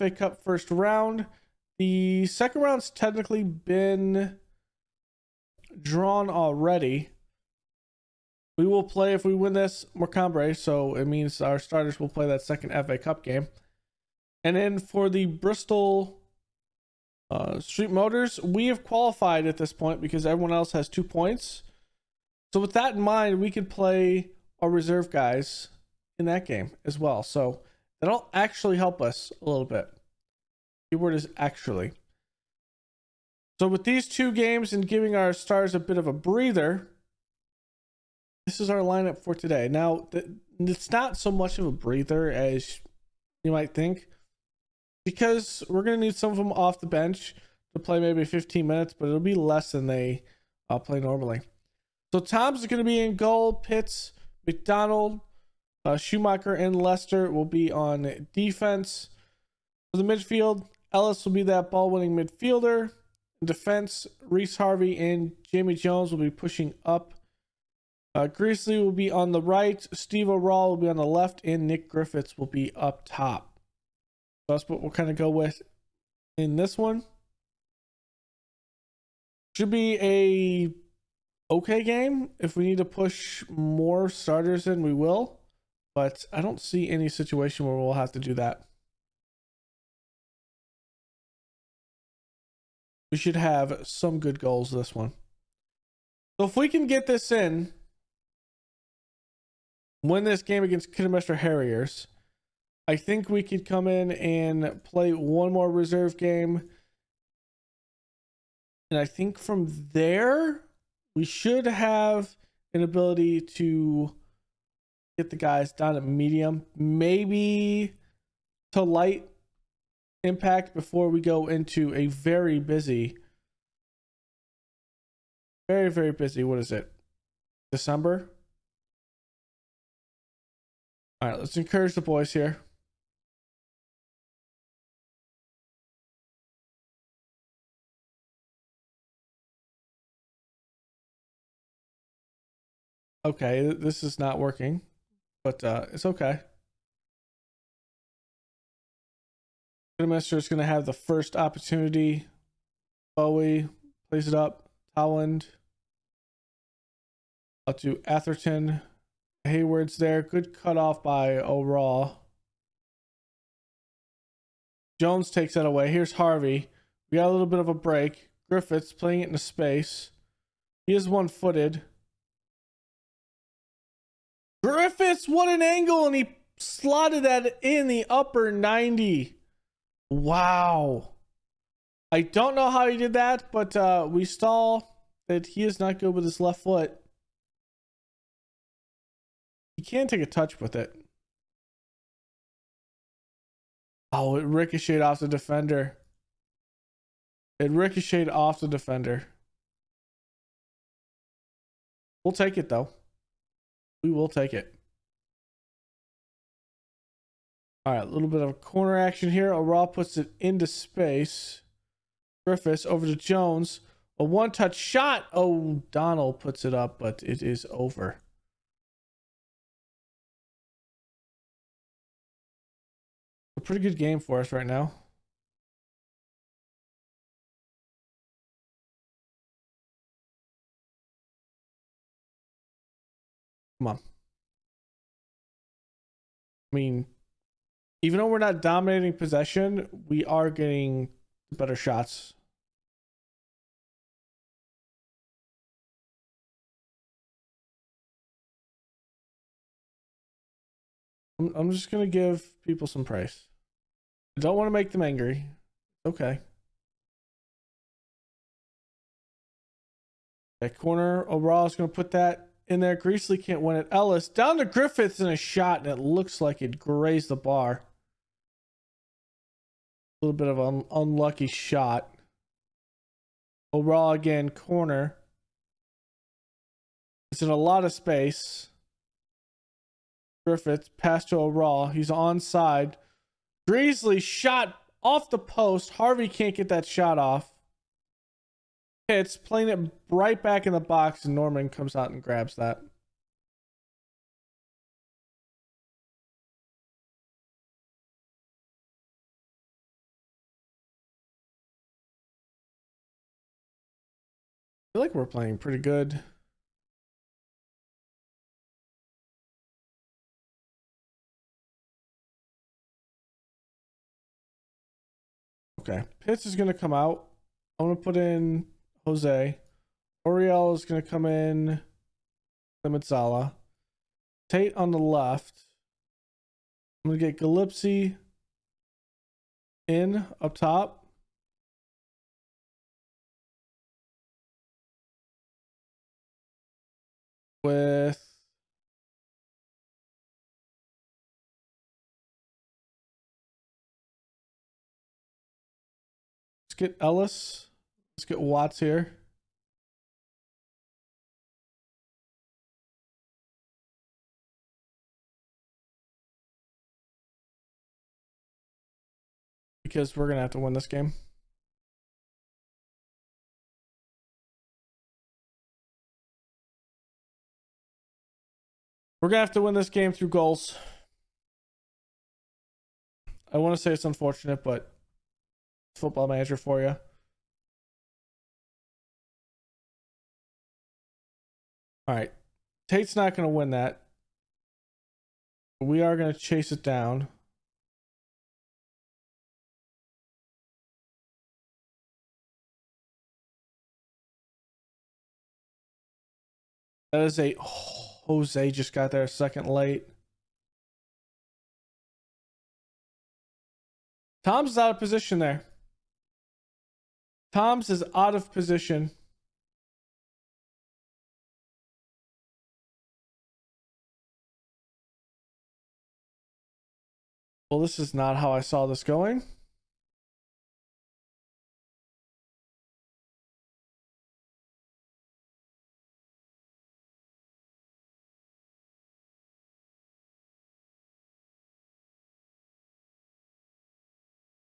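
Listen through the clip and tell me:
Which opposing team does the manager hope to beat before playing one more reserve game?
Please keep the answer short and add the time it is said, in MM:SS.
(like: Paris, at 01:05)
Kidderminster Harriers, at 01:40.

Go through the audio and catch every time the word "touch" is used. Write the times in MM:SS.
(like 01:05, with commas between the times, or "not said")
03:10, 03:34.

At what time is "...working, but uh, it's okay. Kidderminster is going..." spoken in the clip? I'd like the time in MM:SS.
02:24.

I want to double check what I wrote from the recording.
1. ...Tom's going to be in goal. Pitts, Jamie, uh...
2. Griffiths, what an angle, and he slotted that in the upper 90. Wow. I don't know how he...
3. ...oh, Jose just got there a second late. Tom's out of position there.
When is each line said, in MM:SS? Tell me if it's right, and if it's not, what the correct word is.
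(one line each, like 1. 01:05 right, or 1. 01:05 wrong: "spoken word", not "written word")
1. 00:52 wrong: "McDonald", not "Jamie"
2. 02:54 right
3. 06:37 right.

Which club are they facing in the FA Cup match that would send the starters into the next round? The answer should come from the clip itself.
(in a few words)
Morecambe.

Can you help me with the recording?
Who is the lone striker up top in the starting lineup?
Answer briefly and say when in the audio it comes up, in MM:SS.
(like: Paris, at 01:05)
Nick Griffiths, at 01:11.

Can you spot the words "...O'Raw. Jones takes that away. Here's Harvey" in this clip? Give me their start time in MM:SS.
02:41.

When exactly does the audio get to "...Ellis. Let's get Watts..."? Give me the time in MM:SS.
05:46.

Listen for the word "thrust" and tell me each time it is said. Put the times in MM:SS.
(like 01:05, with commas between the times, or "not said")
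not said.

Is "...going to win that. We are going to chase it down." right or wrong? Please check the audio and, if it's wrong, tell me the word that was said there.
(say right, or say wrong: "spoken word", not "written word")
right.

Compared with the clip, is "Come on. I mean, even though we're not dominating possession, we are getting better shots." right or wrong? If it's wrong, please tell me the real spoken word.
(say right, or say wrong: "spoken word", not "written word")
right.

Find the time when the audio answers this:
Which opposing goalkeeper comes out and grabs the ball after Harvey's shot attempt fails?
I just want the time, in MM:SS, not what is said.
04:51.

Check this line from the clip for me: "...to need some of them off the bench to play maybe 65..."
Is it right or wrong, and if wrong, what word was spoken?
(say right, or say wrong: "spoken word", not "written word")
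wrong: "15", not "65".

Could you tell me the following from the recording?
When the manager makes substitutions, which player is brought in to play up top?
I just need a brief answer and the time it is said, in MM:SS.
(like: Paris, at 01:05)
Gillespie, at 05:27.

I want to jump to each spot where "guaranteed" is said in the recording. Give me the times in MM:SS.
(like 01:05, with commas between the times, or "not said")
not said.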